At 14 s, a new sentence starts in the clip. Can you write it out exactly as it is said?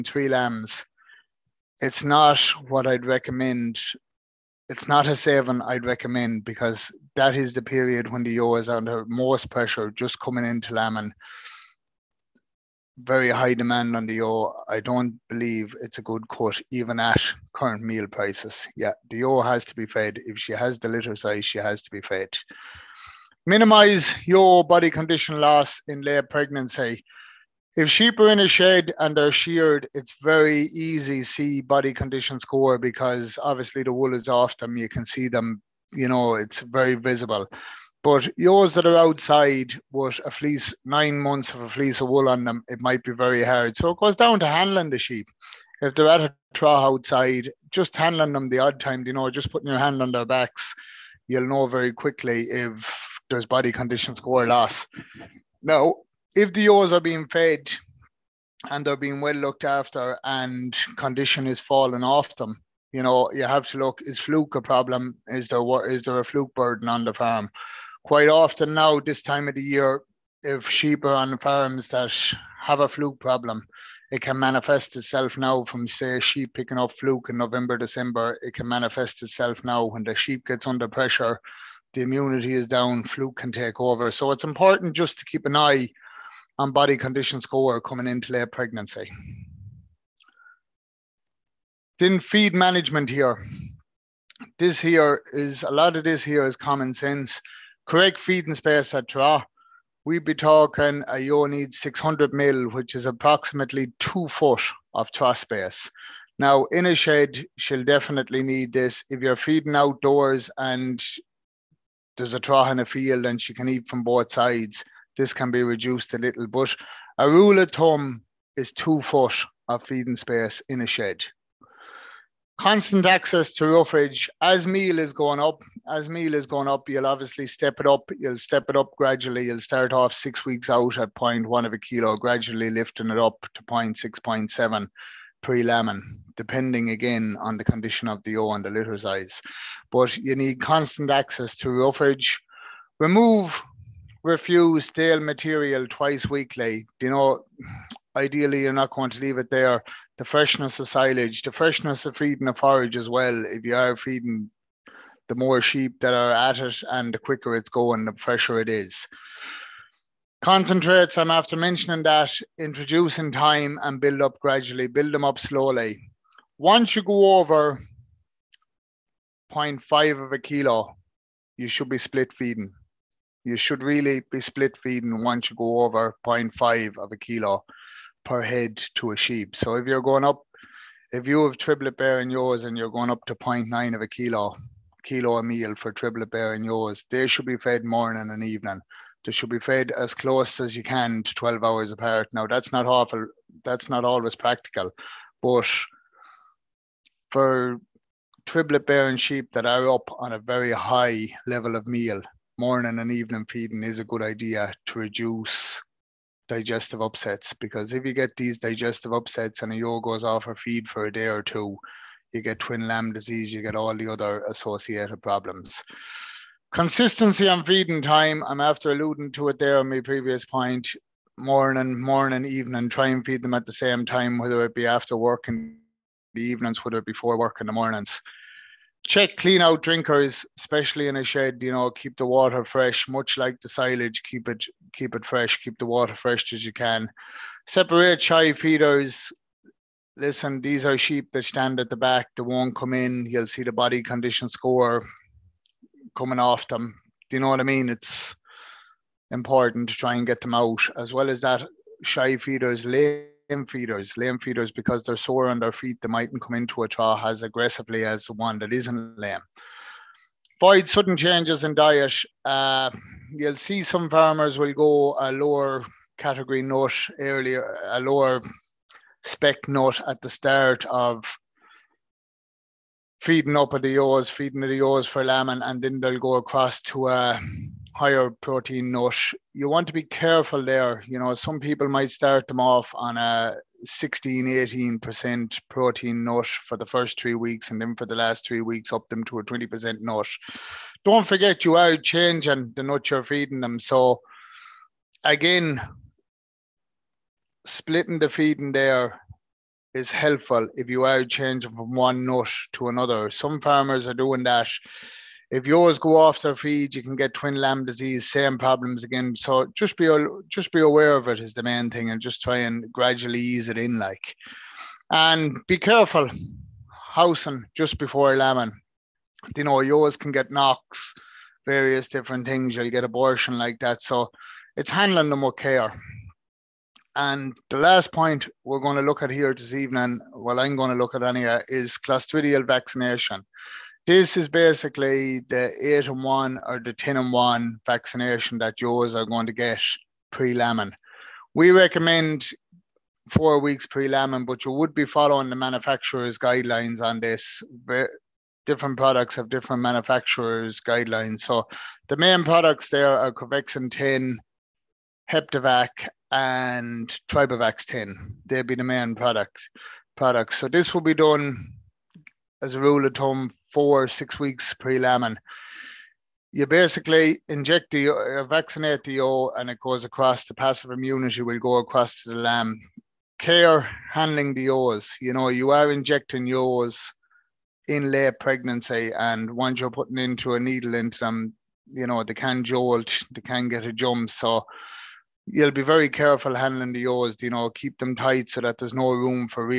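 I don't believe it's a good cut, even at current meal prices.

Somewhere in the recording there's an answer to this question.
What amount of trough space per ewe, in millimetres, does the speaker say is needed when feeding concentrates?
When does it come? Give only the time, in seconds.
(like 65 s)
101 s.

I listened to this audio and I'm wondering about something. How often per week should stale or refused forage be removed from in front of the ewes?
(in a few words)
Twice weekly.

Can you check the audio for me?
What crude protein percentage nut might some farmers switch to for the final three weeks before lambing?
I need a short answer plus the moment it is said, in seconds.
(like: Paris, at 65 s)
20%, at 289 s.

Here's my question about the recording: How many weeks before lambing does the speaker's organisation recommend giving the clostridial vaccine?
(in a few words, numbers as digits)
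4 weeks.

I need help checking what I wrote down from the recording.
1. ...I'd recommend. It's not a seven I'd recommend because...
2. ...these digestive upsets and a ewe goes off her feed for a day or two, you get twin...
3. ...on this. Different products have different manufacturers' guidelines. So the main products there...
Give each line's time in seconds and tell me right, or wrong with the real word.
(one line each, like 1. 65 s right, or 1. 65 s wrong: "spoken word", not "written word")
1. 2 s right
2. 208 s right
3. 347 s right.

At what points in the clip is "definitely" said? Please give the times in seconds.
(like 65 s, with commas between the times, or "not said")
107 s.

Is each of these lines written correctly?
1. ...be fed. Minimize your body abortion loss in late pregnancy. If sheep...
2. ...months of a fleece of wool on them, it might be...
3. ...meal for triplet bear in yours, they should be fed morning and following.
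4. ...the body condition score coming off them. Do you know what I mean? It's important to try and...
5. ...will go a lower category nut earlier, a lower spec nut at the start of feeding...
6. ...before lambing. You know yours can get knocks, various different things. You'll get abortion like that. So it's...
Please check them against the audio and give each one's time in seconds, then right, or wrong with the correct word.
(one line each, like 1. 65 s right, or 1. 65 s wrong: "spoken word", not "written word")
1. 21 s wrong: "condition", not "abortion"
2. 41 s right
3. 185 s wrong: "evening", not "following"
4. 243 s right
5. 264 s right
6. 317 s right.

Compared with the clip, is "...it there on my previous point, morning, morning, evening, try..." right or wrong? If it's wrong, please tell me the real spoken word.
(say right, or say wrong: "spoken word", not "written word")
right.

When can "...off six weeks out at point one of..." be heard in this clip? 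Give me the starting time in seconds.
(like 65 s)
129 s.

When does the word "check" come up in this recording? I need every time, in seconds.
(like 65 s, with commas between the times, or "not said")
229 s.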